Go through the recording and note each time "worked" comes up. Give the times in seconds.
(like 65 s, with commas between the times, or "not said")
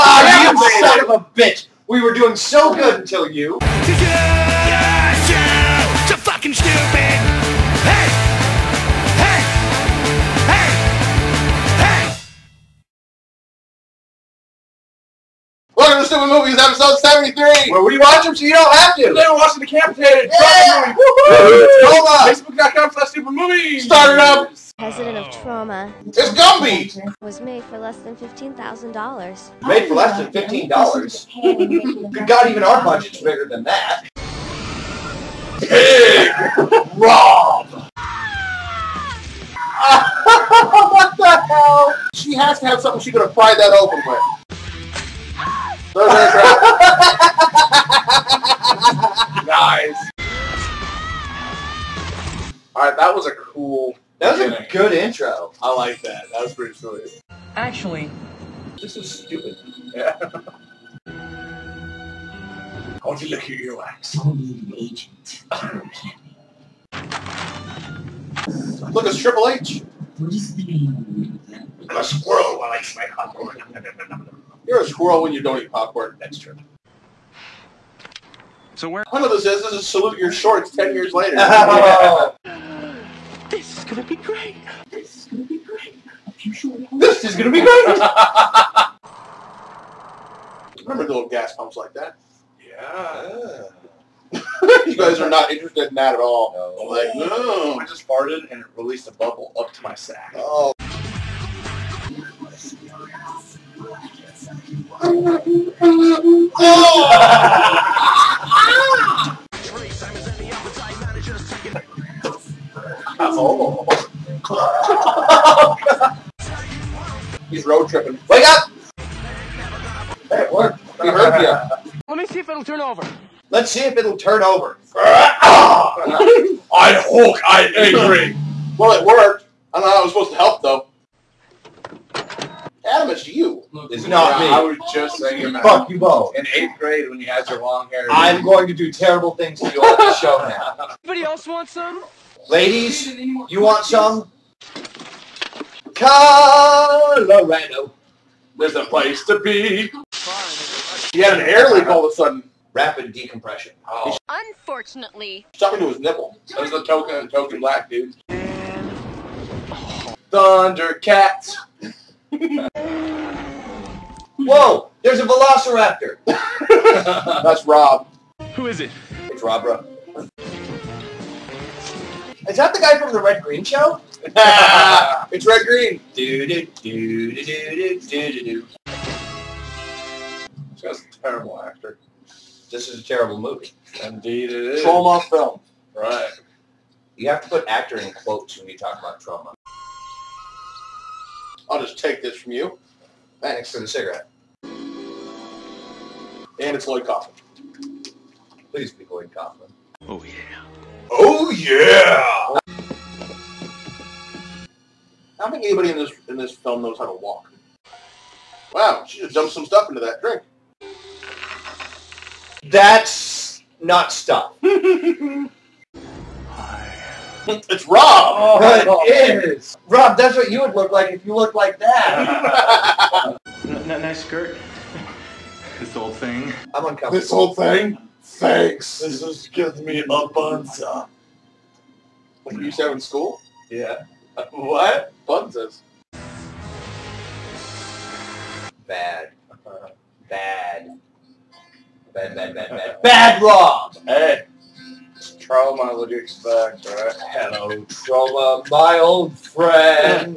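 120 s, 129 s.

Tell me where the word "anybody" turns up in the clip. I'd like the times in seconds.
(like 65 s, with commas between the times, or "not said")
141 s, 205 s.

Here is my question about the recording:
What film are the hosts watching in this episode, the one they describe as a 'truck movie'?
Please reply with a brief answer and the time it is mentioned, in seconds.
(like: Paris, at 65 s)
Decampitated, at 19 s.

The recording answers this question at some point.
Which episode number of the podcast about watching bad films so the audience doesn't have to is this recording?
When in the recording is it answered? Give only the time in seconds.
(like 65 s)
16 s.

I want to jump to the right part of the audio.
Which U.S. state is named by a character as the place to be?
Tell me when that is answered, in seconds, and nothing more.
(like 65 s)
145 s.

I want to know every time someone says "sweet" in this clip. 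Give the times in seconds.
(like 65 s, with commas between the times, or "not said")
56 s.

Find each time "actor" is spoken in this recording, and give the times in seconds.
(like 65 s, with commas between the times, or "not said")
181 s, 187 s.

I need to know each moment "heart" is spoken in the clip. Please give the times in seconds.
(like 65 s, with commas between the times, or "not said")
not said.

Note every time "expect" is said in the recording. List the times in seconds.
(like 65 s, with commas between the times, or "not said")
246 s.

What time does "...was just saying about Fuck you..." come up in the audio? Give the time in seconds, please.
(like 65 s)
134 s.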